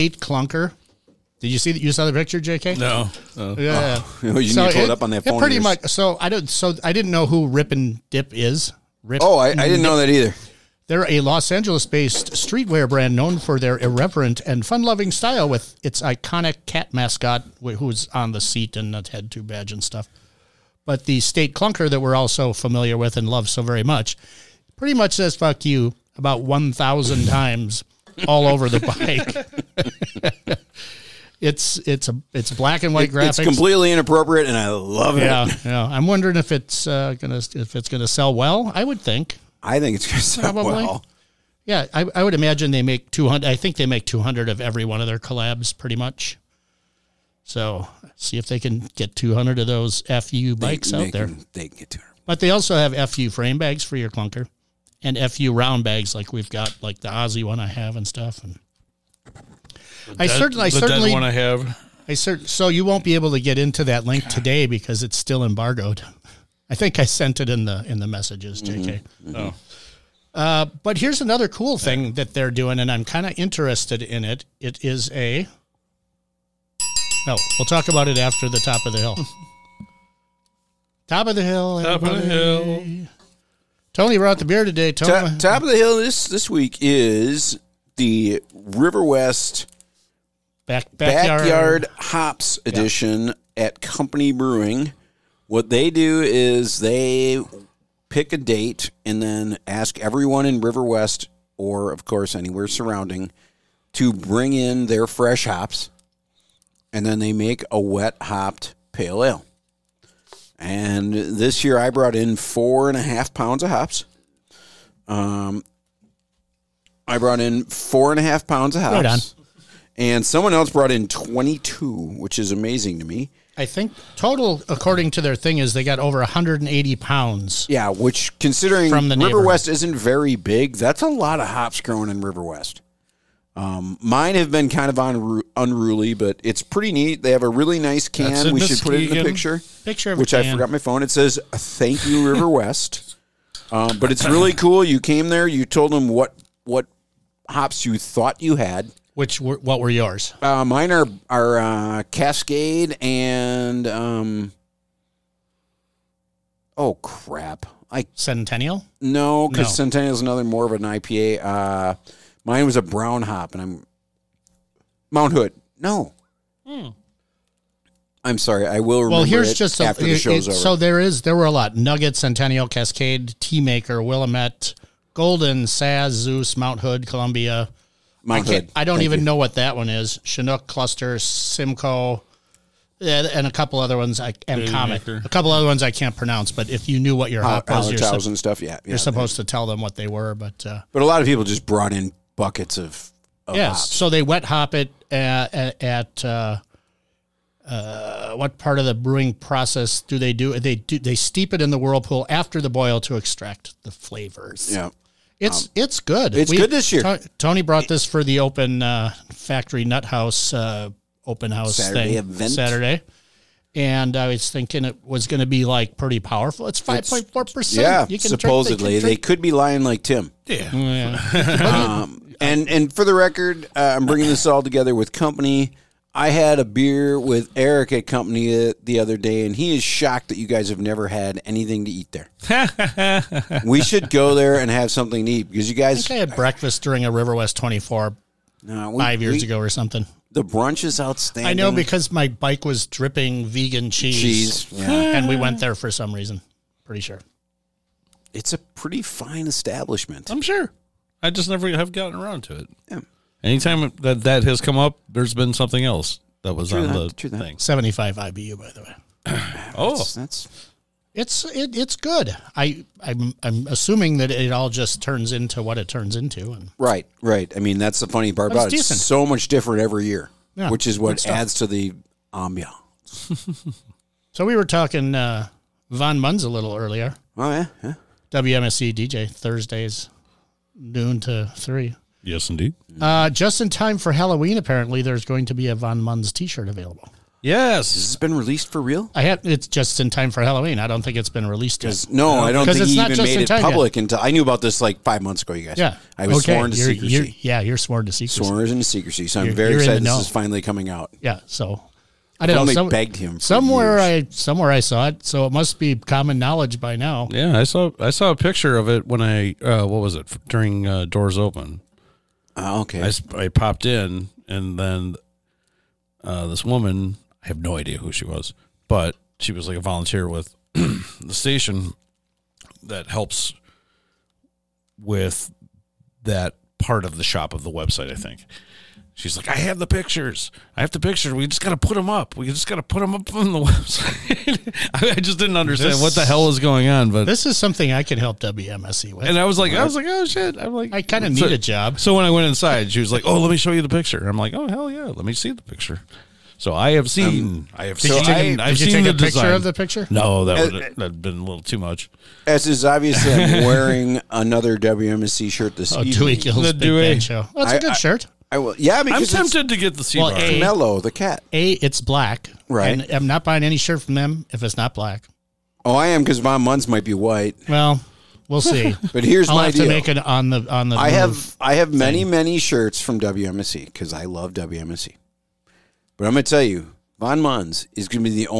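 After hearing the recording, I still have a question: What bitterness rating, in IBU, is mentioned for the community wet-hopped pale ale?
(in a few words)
75 IBU.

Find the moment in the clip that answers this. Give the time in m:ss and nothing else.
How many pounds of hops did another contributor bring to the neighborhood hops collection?
2:01.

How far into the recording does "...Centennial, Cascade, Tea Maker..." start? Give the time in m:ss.
2:52.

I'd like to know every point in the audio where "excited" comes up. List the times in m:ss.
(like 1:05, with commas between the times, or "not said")
4:59.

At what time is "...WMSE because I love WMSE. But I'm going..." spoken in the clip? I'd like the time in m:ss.
6:13.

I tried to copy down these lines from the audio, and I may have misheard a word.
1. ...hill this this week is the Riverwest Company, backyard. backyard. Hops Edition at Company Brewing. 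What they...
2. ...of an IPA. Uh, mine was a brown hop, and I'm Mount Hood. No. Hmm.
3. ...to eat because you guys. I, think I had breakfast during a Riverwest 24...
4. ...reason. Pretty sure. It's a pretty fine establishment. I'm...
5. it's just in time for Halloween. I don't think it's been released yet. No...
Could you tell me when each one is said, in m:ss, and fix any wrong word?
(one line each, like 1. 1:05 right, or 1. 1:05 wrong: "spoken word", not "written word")
1. 1:25 wrong: "Back", not "Company"
2. 2:40 right
3. 3:55 right
4. 4:06 right
5. 4:49 right.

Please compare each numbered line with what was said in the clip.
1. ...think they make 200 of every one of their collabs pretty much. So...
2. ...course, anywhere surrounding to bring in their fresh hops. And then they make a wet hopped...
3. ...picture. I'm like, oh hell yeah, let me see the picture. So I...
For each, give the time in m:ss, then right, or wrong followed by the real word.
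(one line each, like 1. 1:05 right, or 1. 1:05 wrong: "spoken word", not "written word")
1. 0:43 right
2. 1:42 right
3. 5:43 right.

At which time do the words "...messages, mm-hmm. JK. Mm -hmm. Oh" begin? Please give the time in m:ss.
1:08.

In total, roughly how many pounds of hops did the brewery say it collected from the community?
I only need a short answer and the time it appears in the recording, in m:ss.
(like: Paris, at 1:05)
over 180 pounds, at 2:05.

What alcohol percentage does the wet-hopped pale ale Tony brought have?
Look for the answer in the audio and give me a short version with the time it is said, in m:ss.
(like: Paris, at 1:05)
5.4%, at 3:36.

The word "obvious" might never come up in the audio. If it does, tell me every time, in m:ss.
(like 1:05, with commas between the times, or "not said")
5:52.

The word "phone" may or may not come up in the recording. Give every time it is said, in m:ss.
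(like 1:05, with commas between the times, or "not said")
0:05, 2:20.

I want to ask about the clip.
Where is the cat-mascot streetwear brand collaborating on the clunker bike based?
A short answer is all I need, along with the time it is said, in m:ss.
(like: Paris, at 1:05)
Los Angeles, at 0:11.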